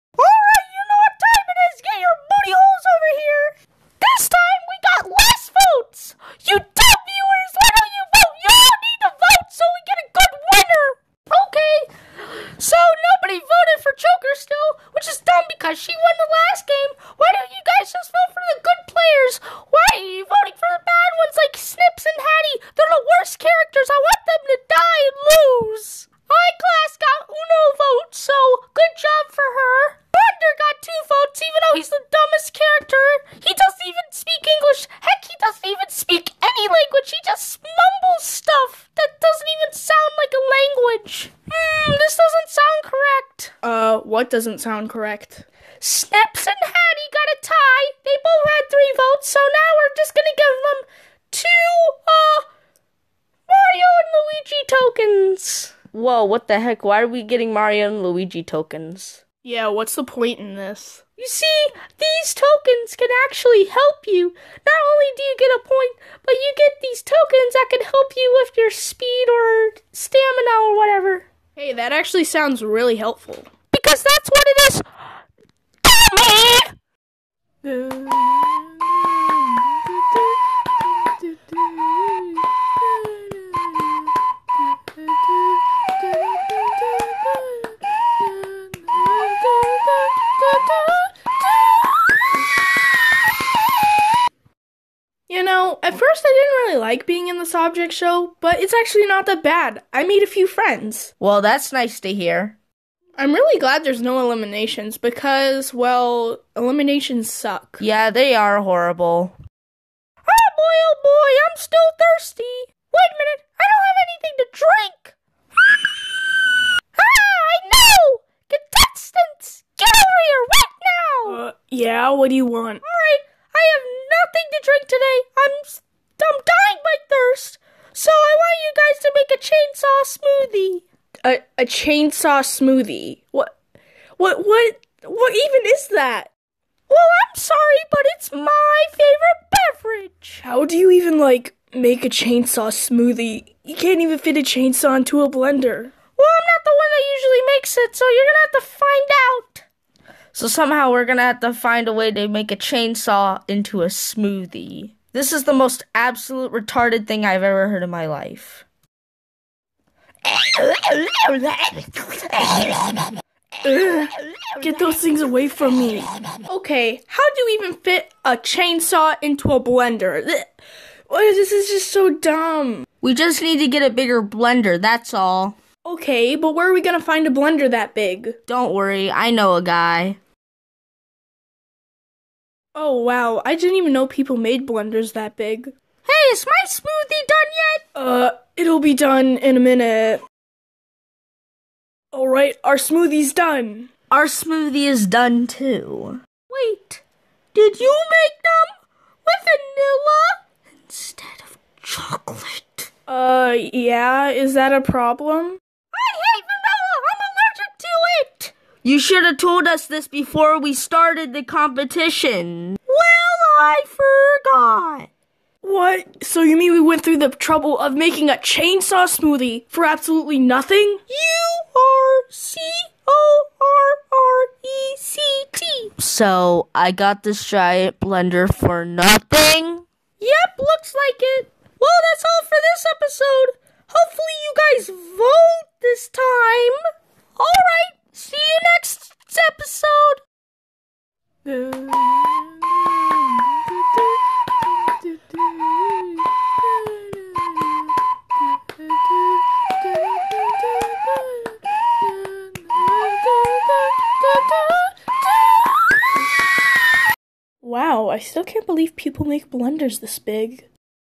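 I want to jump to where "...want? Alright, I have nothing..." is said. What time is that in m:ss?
2:02.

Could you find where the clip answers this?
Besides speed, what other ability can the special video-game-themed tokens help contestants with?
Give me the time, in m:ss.
1:09.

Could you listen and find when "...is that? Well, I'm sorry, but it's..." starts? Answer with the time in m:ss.
2:15.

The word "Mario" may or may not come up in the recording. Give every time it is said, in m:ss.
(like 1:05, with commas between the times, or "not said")
0:53, 0:57.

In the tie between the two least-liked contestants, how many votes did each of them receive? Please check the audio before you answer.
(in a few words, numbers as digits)
3.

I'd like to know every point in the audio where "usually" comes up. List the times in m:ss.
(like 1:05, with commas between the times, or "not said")
2:27.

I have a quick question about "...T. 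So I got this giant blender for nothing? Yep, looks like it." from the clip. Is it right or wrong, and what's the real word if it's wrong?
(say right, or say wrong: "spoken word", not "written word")
right.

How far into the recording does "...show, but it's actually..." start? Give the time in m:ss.
1:37.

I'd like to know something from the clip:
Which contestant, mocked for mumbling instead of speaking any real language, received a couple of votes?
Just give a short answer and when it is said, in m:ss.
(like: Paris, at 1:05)
Bender, at 0:30.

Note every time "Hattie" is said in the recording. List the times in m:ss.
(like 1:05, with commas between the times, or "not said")
0:22, 0:46.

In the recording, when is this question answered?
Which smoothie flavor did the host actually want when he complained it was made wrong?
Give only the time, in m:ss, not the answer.
3:21.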